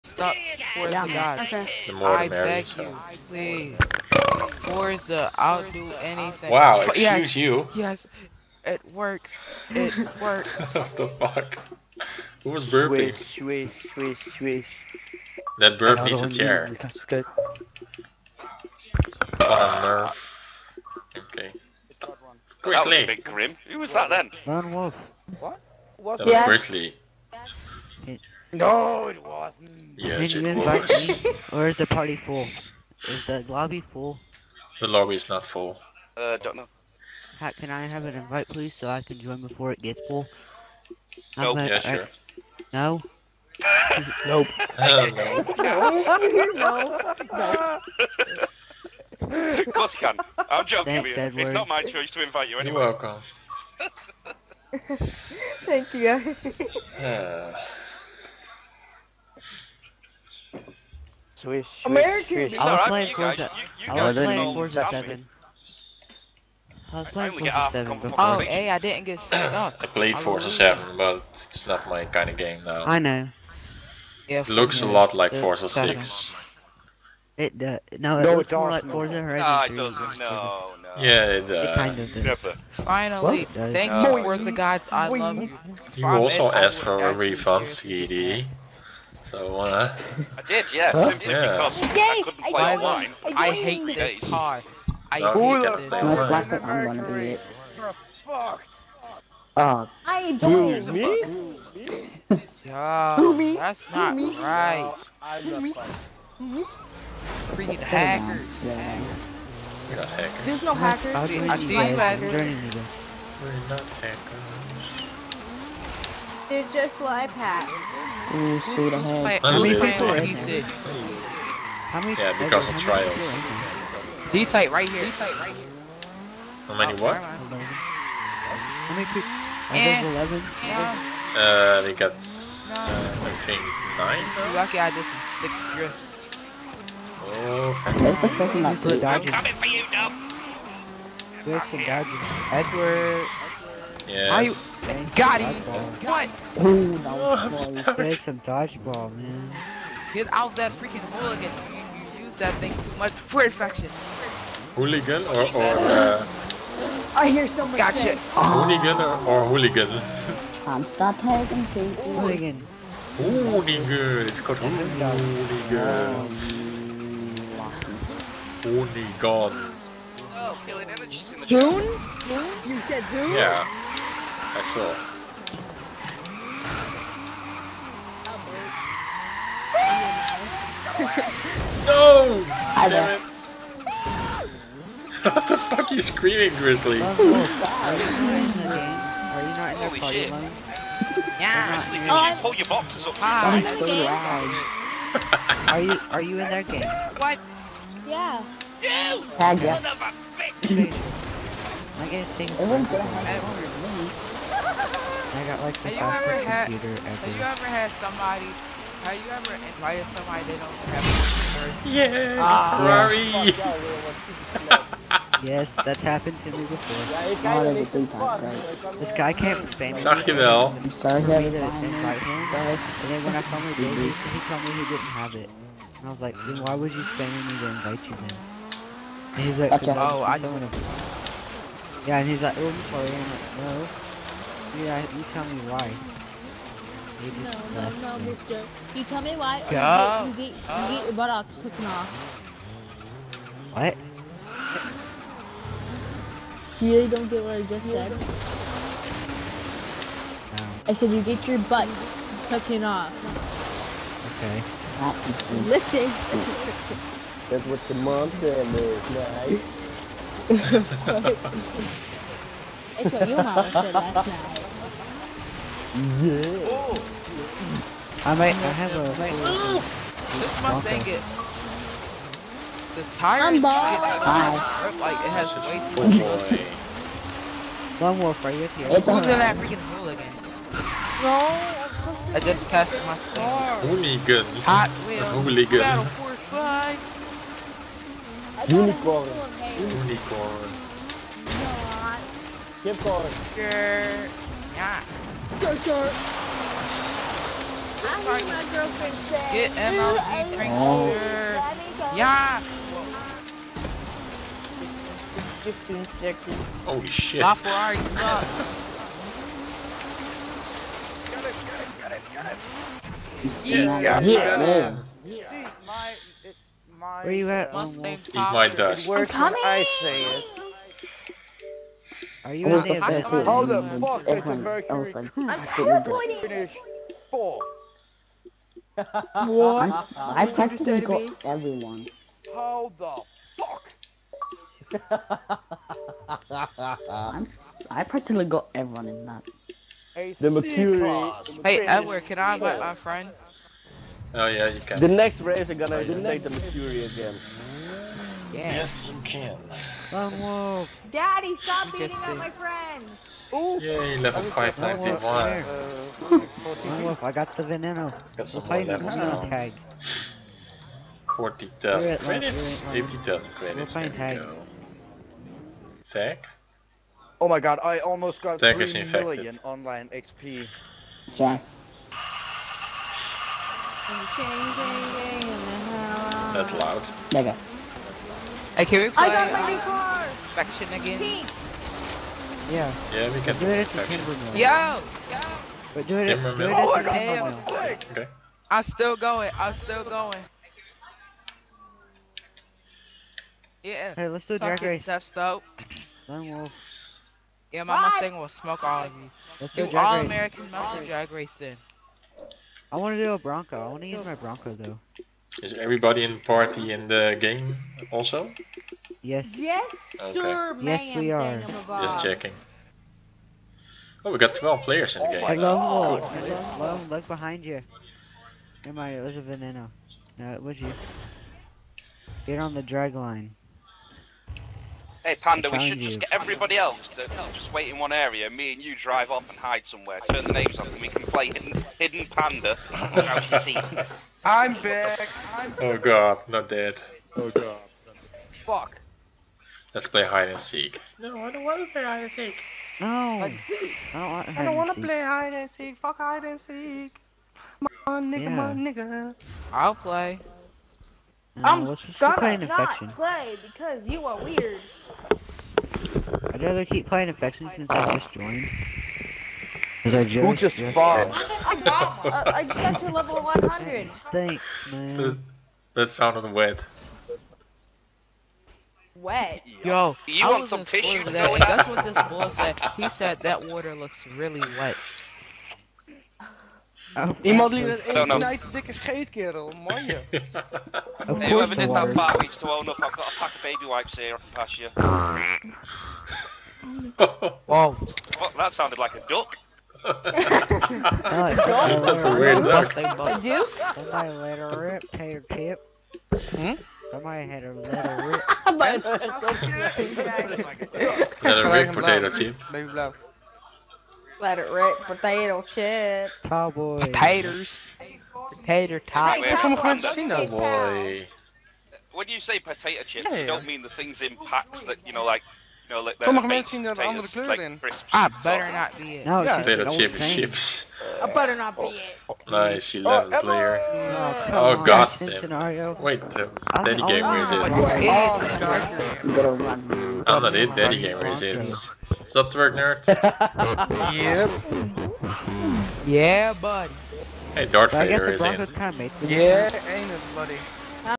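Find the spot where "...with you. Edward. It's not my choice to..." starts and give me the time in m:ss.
0:51.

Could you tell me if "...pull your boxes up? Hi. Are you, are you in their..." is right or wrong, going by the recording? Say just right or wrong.
right.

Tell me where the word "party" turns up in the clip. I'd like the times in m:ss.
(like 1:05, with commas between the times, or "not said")
0:31, 6:46.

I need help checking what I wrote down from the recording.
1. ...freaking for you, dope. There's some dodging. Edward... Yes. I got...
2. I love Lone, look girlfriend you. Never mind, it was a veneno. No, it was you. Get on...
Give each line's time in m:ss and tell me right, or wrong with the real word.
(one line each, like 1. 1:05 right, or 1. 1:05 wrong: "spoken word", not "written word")
1. 2:19 wrong: "coming", not "freaking"
2. 6:55 wrong: "behind", not "girlfriend".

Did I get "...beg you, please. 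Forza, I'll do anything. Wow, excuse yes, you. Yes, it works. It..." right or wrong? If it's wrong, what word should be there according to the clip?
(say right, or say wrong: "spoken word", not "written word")
right.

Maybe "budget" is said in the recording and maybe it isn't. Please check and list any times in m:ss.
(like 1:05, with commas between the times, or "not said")
not said.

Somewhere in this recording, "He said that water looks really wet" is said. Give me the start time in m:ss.
7:52.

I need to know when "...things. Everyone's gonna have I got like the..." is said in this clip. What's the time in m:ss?
3:22.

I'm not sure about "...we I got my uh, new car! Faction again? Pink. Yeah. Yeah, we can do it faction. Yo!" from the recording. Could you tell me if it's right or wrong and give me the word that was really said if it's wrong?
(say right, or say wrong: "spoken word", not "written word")
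right.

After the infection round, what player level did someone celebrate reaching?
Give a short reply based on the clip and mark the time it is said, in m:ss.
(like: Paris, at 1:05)
591, at 5:54.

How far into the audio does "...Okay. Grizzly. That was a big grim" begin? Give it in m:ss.
0:21.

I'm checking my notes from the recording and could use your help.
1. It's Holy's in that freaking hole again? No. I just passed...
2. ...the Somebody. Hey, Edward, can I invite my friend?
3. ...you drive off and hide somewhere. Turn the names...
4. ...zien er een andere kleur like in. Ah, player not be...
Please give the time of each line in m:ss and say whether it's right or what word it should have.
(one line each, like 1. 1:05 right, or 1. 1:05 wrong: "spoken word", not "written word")
1. 4:38 wrong: "Who", not "Holy"
2. 5:40 wrong: "Mercury", not "Somebody"
3. 7:08 right
4. 8:36 wrong: "better", not "player".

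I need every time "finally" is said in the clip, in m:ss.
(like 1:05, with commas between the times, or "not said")
1:22, 3:43.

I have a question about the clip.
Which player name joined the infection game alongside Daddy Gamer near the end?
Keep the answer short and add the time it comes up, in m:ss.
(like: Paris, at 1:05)
Darth Vader, at 8:57.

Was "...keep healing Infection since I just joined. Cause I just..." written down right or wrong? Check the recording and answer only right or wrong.
wrong.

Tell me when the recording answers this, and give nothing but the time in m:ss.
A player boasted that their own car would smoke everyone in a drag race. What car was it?
6:38.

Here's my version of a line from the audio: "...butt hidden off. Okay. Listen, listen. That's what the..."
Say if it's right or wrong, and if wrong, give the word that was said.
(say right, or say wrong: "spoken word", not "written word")
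wrong: "taken", not "hidden".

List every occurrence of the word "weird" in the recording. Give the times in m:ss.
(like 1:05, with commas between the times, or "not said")
7:34, 8:12.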